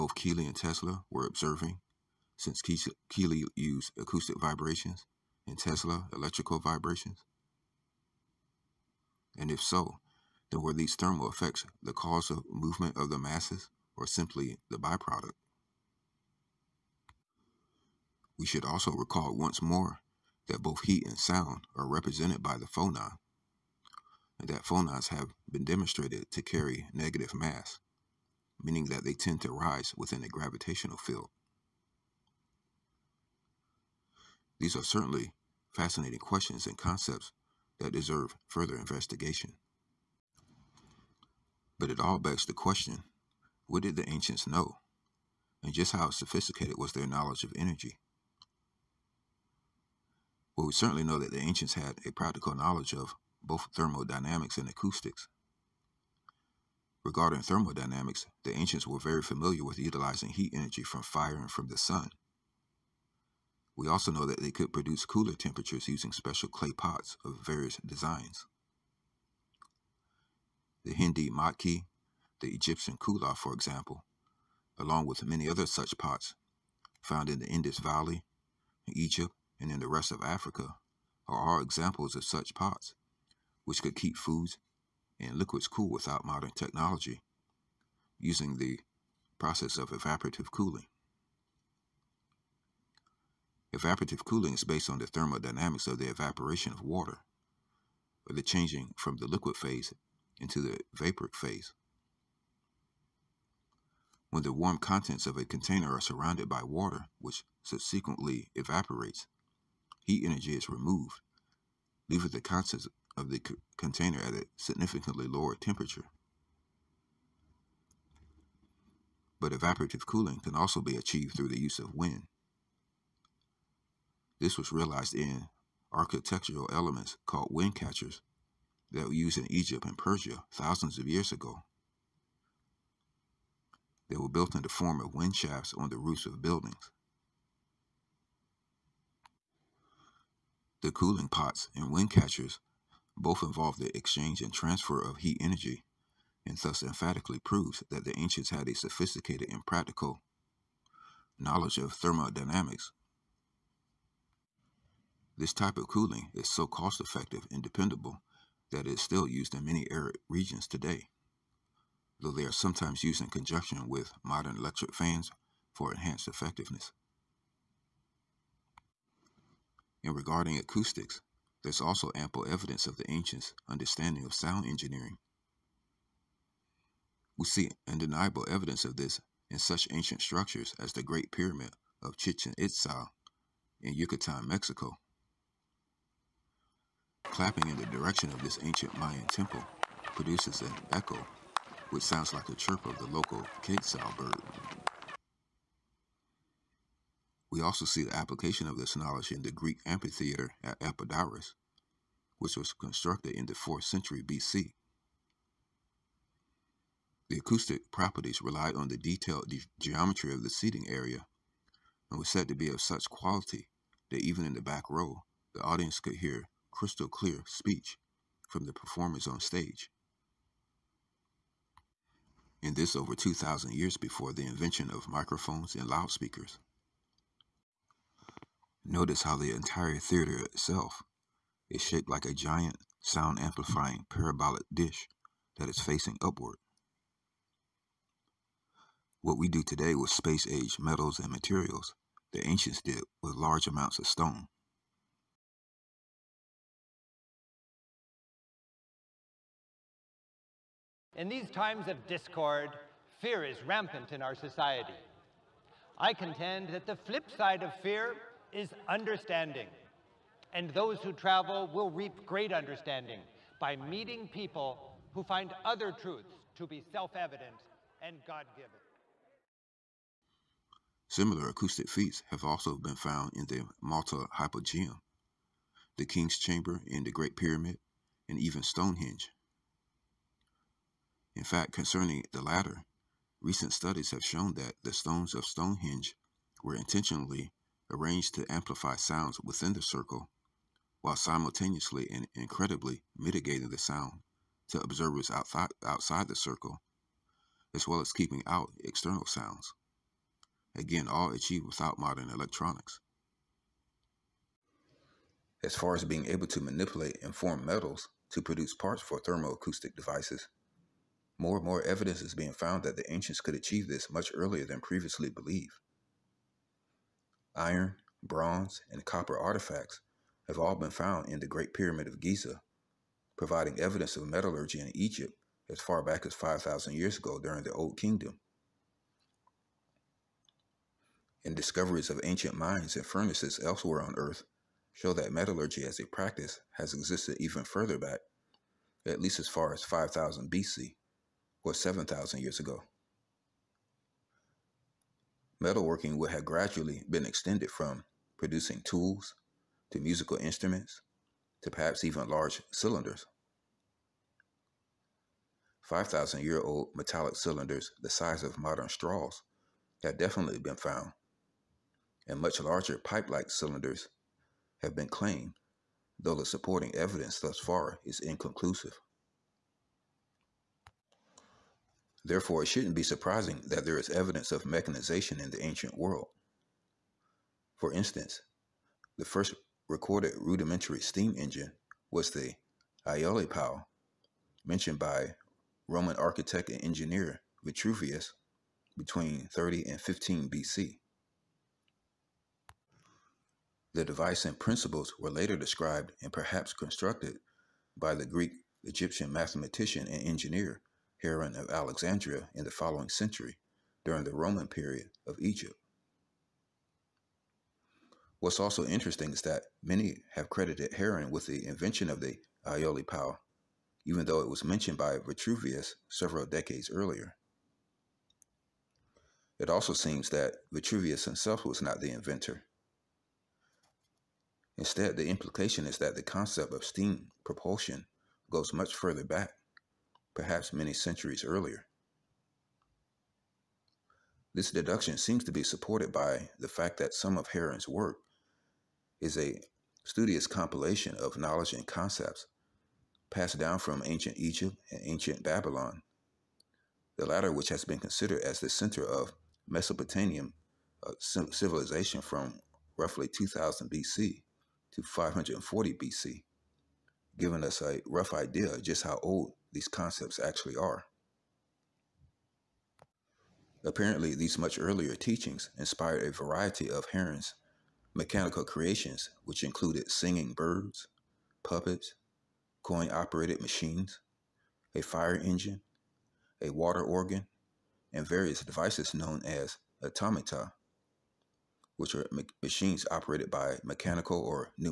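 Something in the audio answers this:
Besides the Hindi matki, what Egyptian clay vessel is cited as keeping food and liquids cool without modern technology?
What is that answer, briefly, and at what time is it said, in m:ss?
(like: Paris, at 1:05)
kula, at 1:12.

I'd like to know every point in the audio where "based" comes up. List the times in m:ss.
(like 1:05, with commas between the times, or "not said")
1:34.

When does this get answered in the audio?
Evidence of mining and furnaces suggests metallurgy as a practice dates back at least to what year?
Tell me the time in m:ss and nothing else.
5:39.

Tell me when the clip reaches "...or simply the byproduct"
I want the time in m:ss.
0:13.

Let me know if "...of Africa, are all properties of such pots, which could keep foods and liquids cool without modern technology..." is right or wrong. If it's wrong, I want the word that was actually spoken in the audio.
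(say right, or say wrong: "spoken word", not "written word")
wrong: "examples", not "properties".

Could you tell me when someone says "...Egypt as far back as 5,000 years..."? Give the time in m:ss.
5:24.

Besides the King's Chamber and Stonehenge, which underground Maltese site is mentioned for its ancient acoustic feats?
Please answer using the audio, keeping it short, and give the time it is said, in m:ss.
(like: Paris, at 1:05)
Malta Hypogeum, at 4:33.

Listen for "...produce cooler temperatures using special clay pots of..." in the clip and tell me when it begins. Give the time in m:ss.
1:04.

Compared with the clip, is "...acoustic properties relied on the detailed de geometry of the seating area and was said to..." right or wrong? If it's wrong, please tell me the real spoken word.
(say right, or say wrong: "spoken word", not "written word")
right.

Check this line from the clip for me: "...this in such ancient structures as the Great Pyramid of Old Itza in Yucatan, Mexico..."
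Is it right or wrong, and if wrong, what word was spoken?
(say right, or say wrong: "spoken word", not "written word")
wrong: "Chichen", not "Old".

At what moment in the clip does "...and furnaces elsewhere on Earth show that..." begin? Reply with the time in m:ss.
5:32.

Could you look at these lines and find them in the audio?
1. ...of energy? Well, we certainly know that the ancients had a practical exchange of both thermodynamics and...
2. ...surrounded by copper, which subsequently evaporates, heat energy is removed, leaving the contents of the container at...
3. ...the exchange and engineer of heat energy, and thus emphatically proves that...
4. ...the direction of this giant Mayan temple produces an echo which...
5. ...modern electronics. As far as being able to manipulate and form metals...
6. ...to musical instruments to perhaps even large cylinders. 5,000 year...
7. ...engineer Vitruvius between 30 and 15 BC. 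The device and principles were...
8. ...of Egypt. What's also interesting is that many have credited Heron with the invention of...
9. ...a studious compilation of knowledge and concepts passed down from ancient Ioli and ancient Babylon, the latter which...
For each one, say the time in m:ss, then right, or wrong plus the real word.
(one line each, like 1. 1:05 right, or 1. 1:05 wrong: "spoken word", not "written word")
1. 0:47 wrong: "knowledge", not "exchange"
2. 1:45 wrong: "water", not "copper"
3. 2:23 wrong: "transfer", not "engineer"
4. 3:07 wrong: "ancient", not "giant"
5. 5:01 right
6. 5:49 right
7. 6:26 right
8. 6:45 right
9. 7:19 wrong: "Egypt", not "Ioli".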